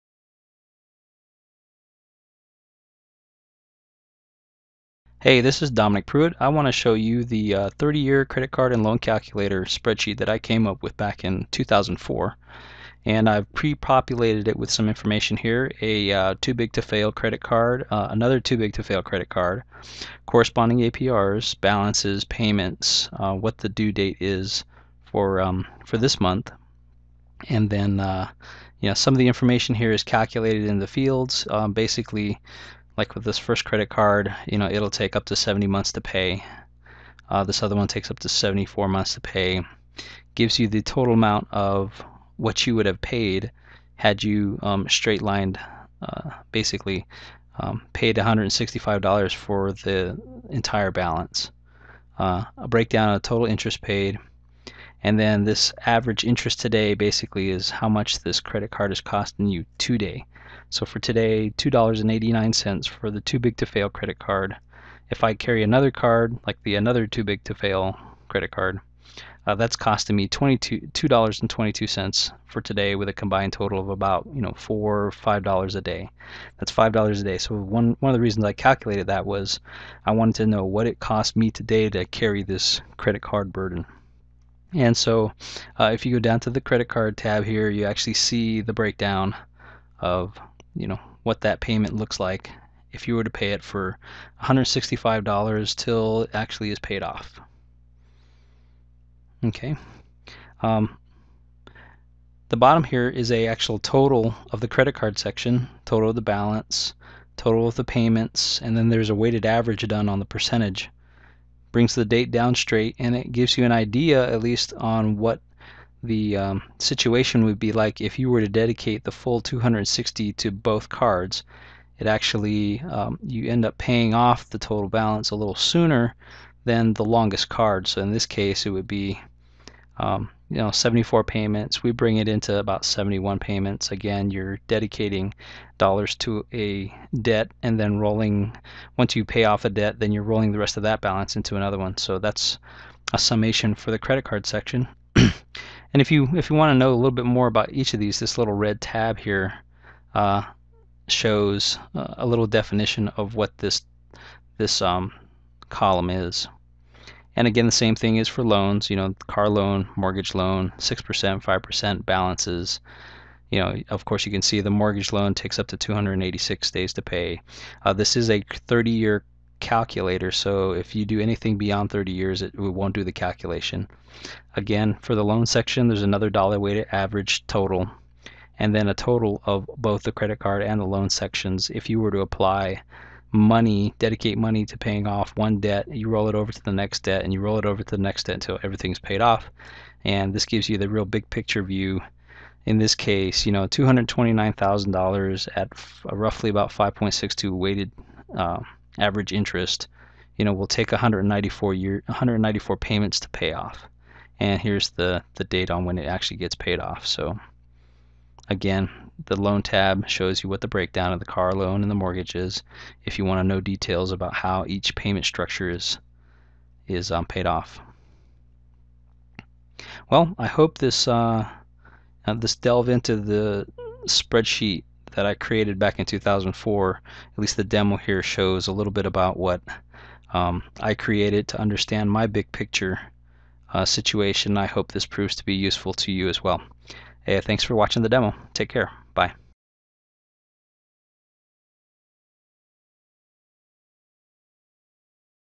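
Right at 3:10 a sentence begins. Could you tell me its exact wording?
And this gives you the real big picture view.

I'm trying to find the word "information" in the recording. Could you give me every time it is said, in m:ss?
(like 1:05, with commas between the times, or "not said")
0:14, 0:29.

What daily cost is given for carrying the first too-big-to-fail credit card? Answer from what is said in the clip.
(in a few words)
$2.89.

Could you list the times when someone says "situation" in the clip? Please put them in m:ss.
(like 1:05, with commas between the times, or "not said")
1:56, 3:53.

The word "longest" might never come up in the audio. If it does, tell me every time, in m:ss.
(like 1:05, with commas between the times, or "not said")
2:07.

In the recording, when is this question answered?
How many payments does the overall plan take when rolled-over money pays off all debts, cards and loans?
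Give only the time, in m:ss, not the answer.
3:22.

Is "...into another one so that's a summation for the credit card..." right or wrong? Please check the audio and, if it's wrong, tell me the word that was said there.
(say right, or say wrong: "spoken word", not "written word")
right.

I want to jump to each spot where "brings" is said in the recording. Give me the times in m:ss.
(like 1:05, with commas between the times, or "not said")
1:51, 2:11.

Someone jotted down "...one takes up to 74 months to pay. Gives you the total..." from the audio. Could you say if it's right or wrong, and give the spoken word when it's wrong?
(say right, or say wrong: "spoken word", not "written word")
right.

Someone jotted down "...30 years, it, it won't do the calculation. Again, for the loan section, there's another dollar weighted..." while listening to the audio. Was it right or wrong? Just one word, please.
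right.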